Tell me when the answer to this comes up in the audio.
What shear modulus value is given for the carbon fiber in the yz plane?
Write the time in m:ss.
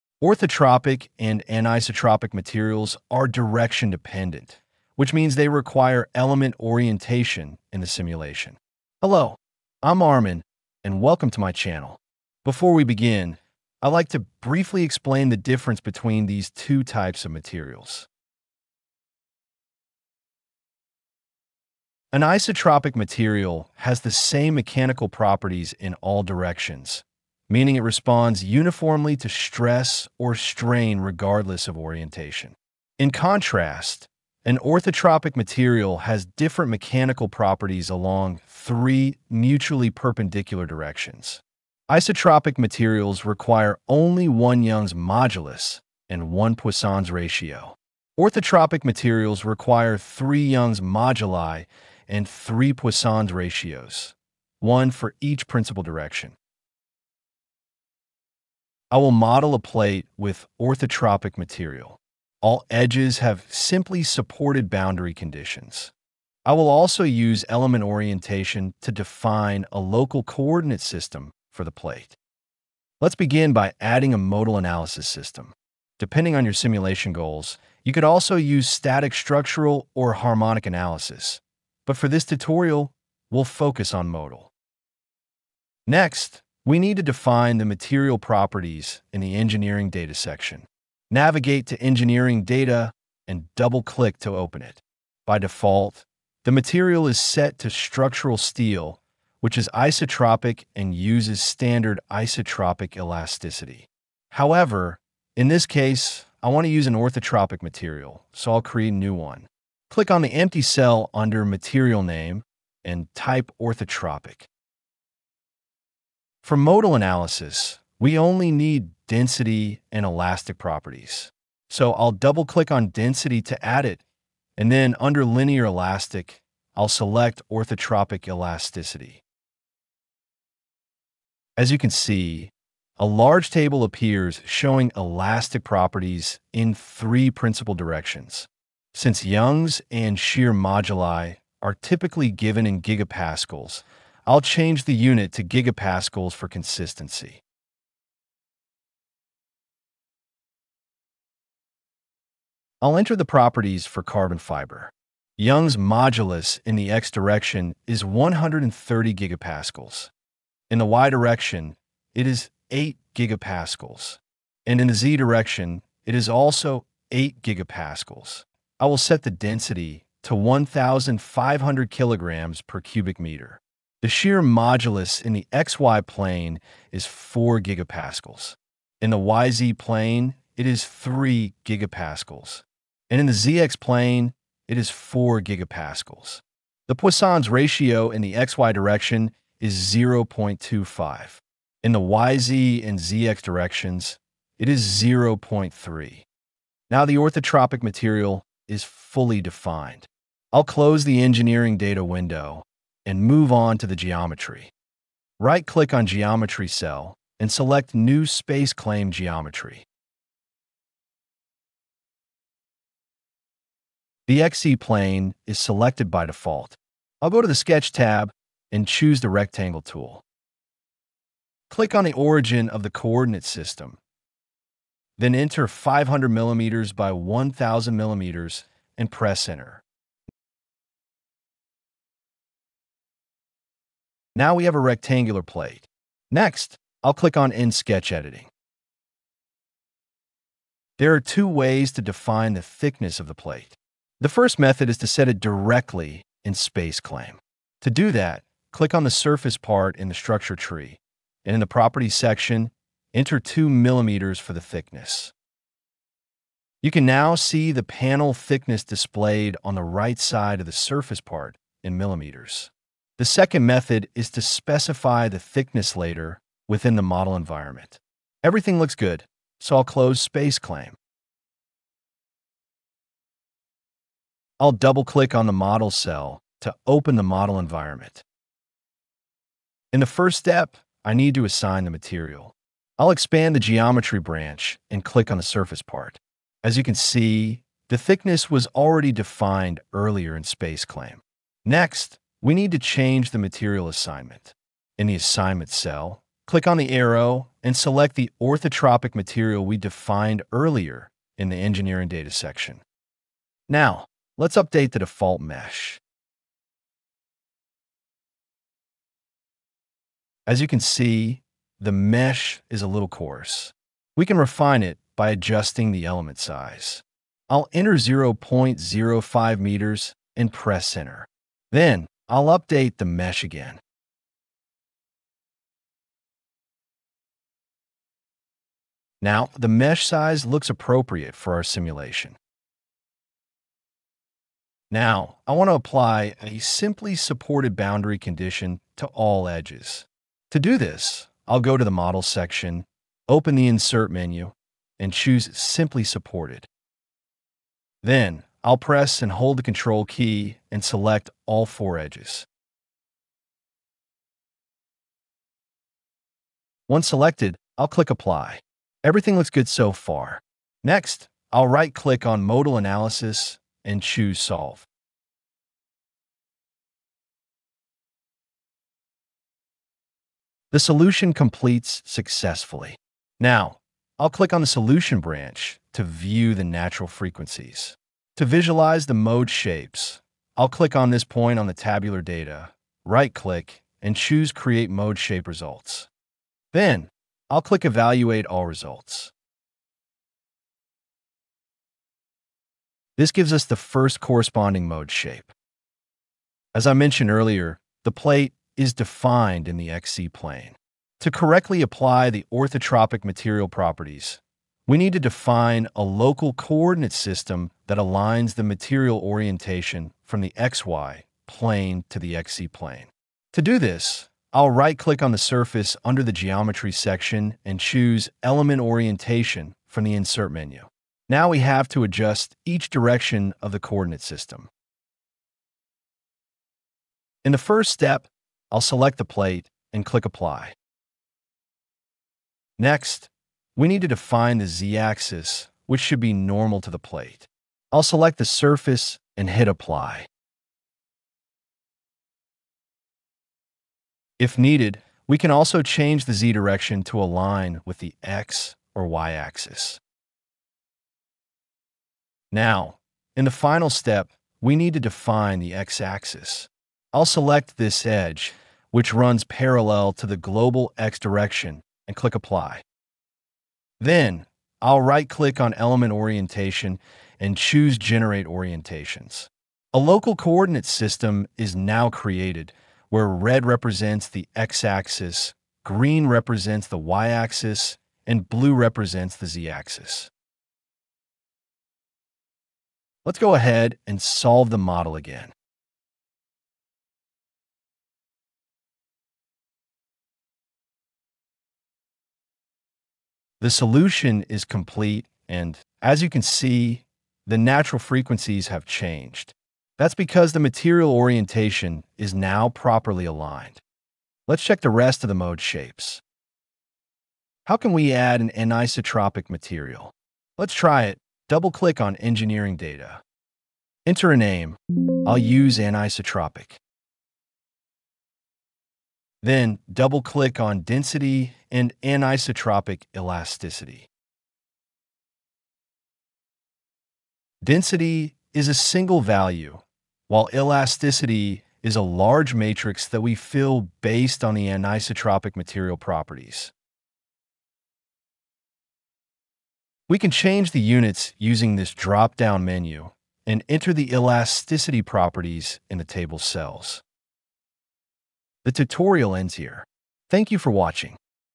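3:00.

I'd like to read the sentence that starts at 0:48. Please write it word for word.
Orthotropic materials require three Young's moduli and three Poisson's ratios, one for each principal direction.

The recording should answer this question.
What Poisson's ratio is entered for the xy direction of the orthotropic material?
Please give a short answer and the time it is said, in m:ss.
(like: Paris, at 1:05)
0.25, at 3:09.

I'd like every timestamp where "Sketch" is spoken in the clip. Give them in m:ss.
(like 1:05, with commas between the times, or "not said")
3:37, 3:57.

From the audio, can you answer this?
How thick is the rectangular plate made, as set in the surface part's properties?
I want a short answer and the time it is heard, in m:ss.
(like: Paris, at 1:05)
2 millimeters, at 4:13.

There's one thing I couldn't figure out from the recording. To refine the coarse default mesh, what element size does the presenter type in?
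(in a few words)
0.05 meters.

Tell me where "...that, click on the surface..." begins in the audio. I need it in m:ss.
4:08.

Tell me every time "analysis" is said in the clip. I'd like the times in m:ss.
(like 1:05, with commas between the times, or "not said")
1:14, 1:20, 1:56, 6:02.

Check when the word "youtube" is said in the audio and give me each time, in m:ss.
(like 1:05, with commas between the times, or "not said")
not said.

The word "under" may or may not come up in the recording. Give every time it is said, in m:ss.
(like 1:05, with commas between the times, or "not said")
1:51, 2:04, 6:56.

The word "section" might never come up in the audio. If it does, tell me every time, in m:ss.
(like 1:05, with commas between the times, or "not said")
1:30, 4:12, 5:02, 5:42, 6:56.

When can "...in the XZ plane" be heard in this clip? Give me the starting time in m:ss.
6:39.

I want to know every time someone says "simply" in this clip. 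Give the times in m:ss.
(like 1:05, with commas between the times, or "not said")
1:03, 5:36, 5:45.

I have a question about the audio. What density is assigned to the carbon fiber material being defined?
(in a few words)
1,500 kg/m³.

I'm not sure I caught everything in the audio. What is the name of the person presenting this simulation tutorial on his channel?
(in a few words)
Armin.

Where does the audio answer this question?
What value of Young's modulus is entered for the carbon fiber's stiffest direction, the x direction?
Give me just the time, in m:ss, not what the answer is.
2:38.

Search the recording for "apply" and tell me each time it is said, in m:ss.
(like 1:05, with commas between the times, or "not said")
5:35, 5:58, 6:41, 7:10, 7:19, 7:42.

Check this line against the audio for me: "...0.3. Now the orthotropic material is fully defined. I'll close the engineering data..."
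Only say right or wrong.
right.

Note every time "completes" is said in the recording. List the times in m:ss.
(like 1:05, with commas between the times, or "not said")
6:11, 8:14.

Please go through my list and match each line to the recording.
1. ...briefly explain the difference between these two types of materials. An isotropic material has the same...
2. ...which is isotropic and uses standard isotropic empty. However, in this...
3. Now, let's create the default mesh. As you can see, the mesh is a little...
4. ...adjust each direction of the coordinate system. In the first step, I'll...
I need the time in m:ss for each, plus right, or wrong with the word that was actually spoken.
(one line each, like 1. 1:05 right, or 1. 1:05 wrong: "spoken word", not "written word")
1. 0:14 right
2. 1:39 wrong: "elasticity", not "empty"
3. 5:03 wrong: "update", not "create"
4. 7:02 right.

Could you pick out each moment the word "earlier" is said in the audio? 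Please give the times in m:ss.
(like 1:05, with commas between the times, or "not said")
4:49, 5:00, 6:37.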